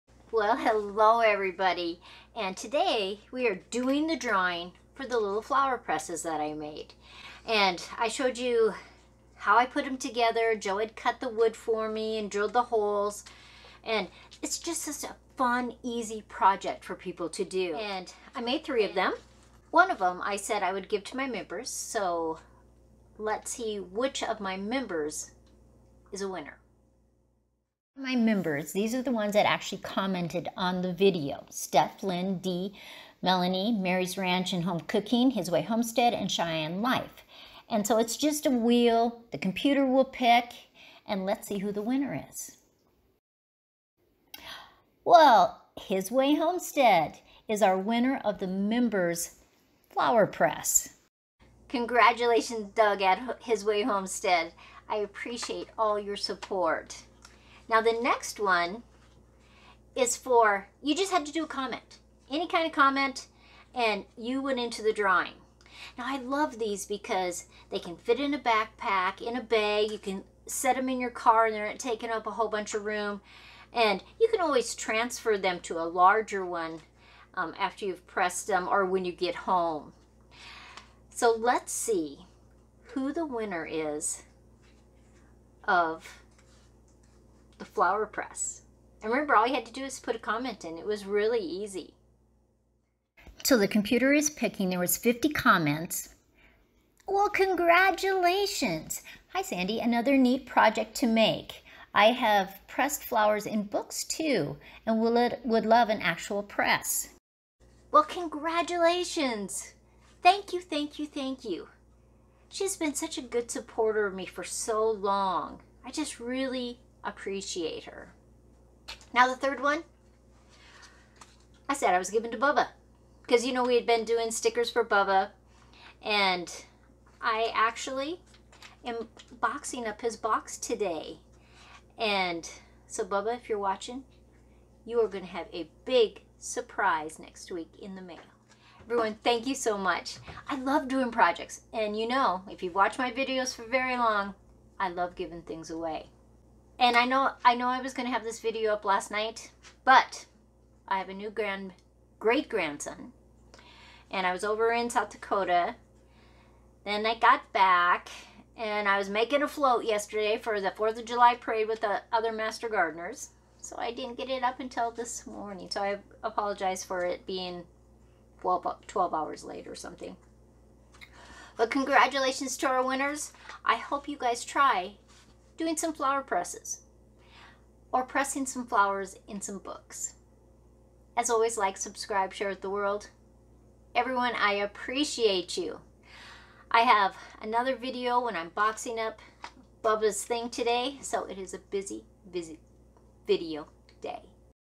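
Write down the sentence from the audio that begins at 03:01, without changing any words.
As always, like, subscribe, share with the world.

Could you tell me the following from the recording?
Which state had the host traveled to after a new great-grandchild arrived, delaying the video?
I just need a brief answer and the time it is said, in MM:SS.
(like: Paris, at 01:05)
South Dakota, at 02:34.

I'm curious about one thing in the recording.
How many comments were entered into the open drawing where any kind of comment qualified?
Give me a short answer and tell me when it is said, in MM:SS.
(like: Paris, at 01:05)
50, at 01:34.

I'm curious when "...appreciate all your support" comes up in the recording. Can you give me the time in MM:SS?
00:54.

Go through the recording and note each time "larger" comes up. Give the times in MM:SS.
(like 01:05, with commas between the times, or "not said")
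01:15.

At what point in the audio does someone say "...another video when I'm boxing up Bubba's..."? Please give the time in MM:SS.
03:07.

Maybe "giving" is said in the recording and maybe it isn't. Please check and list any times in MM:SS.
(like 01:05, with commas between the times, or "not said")
02:02, 02:25.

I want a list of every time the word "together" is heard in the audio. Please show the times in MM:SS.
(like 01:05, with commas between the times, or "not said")
00:09.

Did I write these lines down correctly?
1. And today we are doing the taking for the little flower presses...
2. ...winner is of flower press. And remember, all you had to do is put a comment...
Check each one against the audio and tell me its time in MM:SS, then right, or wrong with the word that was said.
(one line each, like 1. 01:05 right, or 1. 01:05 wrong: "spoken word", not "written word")
1. 00:02 wrong: "drawing", not "taking"
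2. 01:23 right.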